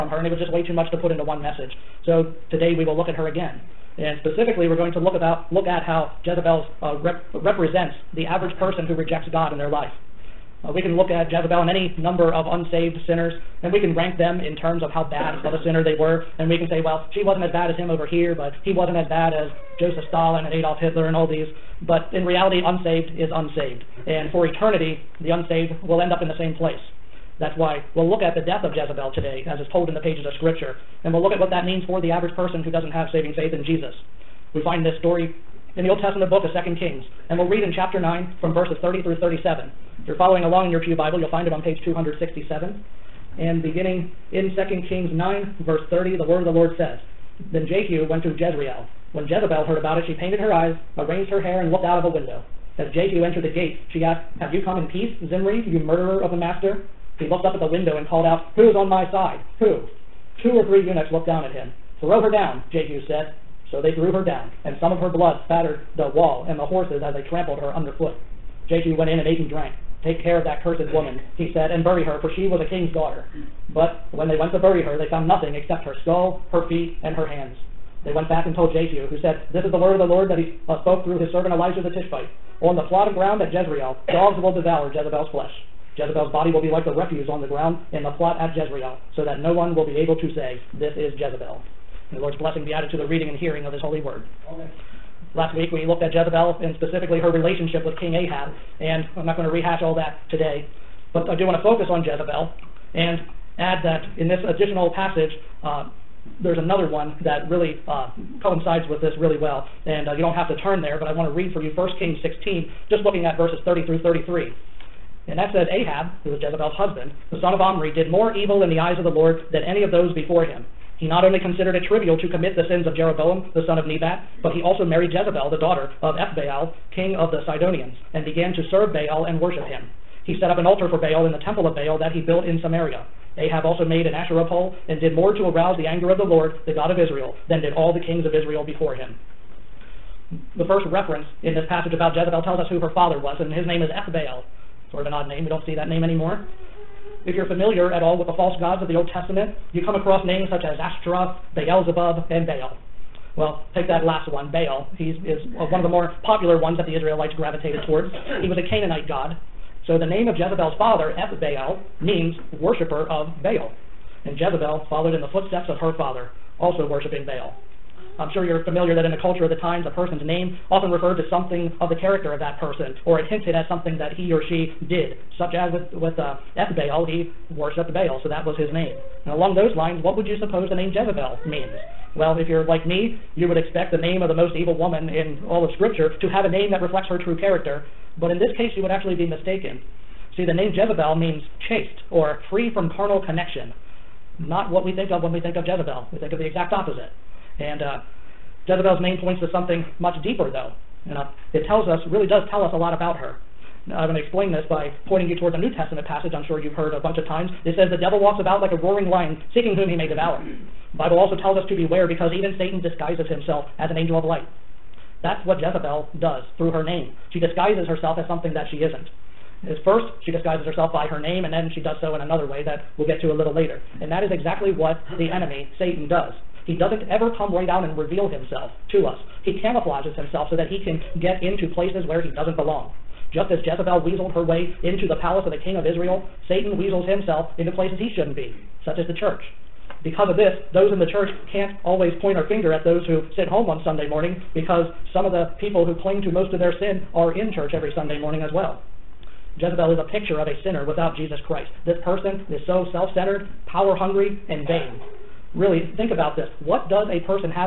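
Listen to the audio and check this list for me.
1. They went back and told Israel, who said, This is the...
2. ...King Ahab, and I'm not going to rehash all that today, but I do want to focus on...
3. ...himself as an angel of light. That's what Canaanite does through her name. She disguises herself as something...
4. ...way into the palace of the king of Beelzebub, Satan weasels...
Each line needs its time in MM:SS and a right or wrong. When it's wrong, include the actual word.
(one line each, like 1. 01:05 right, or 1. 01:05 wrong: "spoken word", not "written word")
1. 01:18 wrong: "Jehu", not "Israel"
2. 01:38 right
3. 03:33 wrong: "Jezebel", not "Canaanite"
4. 03:54 wrong: "Israel", not "Beelzebub".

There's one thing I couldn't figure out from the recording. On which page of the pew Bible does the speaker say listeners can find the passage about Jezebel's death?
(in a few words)
267.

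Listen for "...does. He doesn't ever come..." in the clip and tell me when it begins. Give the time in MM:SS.
03:46.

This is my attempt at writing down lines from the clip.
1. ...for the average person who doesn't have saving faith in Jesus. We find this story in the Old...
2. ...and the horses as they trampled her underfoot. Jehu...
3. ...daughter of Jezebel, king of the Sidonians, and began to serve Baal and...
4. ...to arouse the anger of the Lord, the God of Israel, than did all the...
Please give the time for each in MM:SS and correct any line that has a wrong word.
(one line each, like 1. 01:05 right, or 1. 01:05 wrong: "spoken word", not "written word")
1. 00:31 right
2. 01:06 right
3. 02:05 wrong: "Ethbaal", not "Jezebel"
4. 02:15 right.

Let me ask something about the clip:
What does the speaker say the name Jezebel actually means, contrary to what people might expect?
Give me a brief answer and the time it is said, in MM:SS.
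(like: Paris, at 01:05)
Chaste, at 03:11.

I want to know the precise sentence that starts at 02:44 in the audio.
And Jezebel followed in the footsteps of her father, also worshiping Baal.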